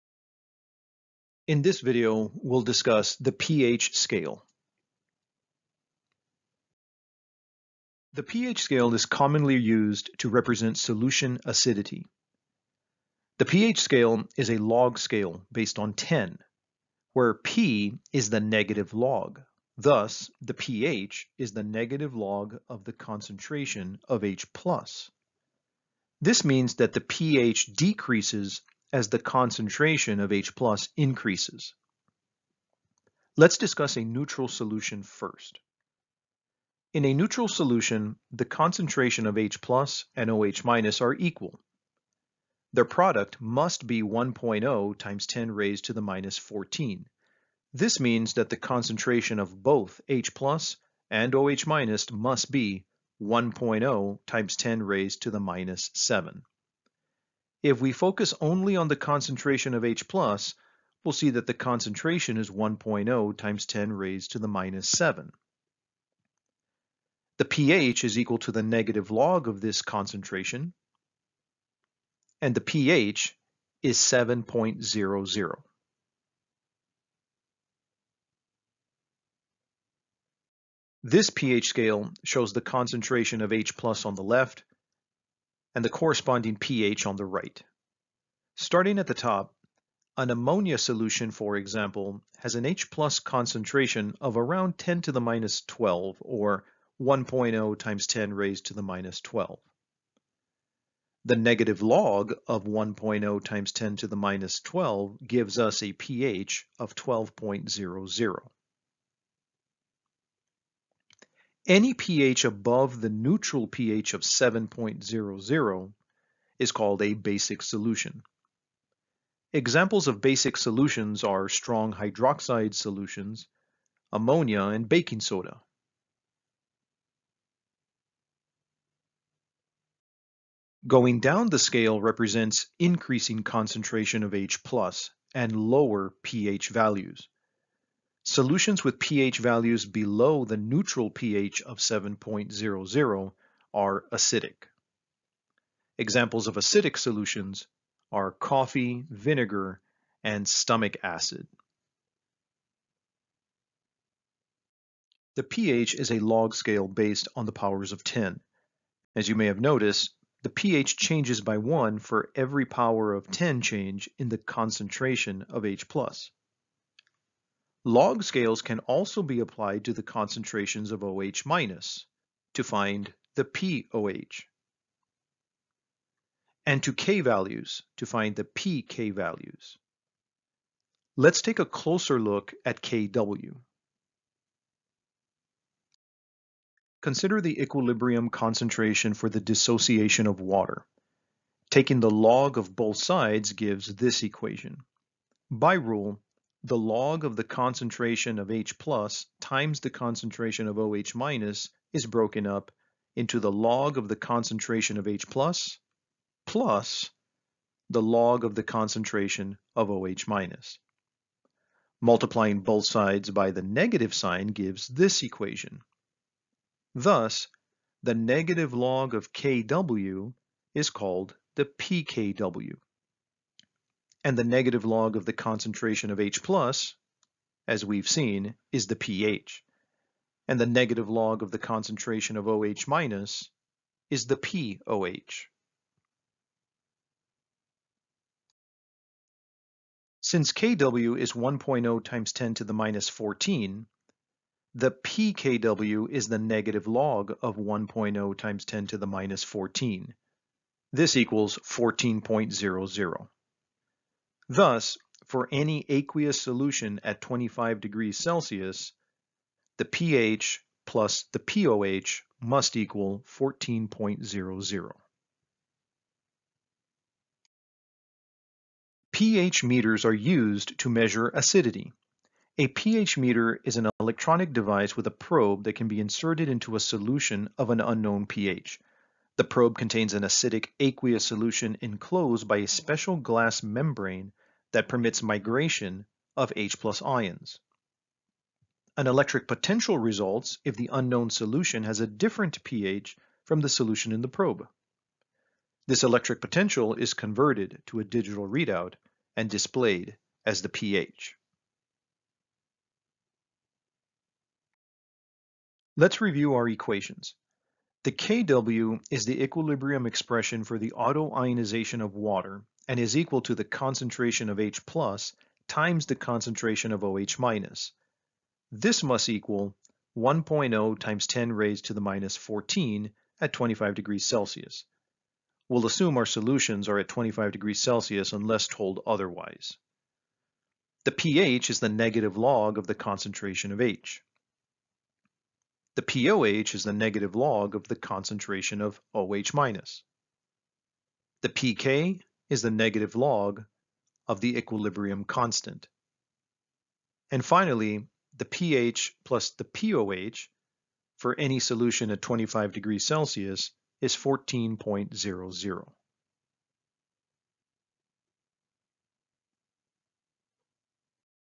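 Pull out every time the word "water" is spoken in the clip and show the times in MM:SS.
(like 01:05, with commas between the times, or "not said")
03:10, 05:12.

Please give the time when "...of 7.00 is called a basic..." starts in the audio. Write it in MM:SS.
01:54.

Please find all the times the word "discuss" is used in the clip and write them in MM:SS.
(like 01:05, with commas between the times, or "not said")
00:02, 00:33.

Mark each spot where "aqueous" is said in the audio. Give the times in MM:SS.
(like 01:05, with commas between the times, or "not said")
04:15, 04:40.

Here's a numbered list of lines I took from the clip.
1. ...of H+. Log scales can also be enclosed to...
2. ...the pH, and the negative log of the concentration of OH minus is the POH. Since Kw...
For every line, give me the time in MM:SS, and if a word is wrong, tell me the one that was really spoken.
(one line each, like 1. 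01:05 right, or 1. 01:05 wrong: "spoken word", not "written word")
1. 02:45 wrong: "applied", not "enclosed"
2. 03:48 right.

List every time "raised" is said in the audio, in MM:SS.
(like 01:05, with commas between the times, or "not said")
00:45, 00:54, 01:03, 01:38, 05:21.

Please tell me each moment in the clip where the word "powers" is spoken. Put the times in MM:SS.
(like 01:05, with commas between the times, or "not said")
02:37, 02:42.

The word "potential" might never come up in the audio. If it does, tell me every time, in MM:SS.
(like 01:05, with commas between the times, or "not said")
04:49, 04:56.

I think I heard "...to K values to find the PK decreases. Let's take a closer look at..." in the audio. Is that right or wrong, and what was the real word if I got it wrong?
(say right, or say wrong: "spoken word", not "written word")
wrong: "values", not "decreases".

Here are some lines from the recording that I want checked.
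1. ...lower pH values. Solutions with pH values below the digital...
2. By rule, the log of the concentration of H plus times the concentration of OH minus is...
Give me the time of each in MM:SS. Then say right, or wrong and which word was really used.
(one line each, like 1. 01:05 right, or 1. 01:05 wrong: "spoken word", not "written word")
1. 02:15 wrong: "neutral", not "digital"
2. 03:15 right.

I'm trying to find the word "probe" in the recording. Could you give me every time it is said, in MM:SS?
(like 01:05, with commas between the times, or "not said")
04:35, 04:39, 04:54.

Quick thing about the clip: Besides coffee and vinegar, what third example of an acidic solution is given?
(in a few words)
stomach acid.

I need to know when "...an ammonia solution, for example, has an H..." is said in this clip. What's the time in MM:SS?
01:30.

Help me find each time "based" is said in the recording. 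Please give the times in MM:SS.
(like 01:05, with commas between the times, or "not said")
00:15, 02:36.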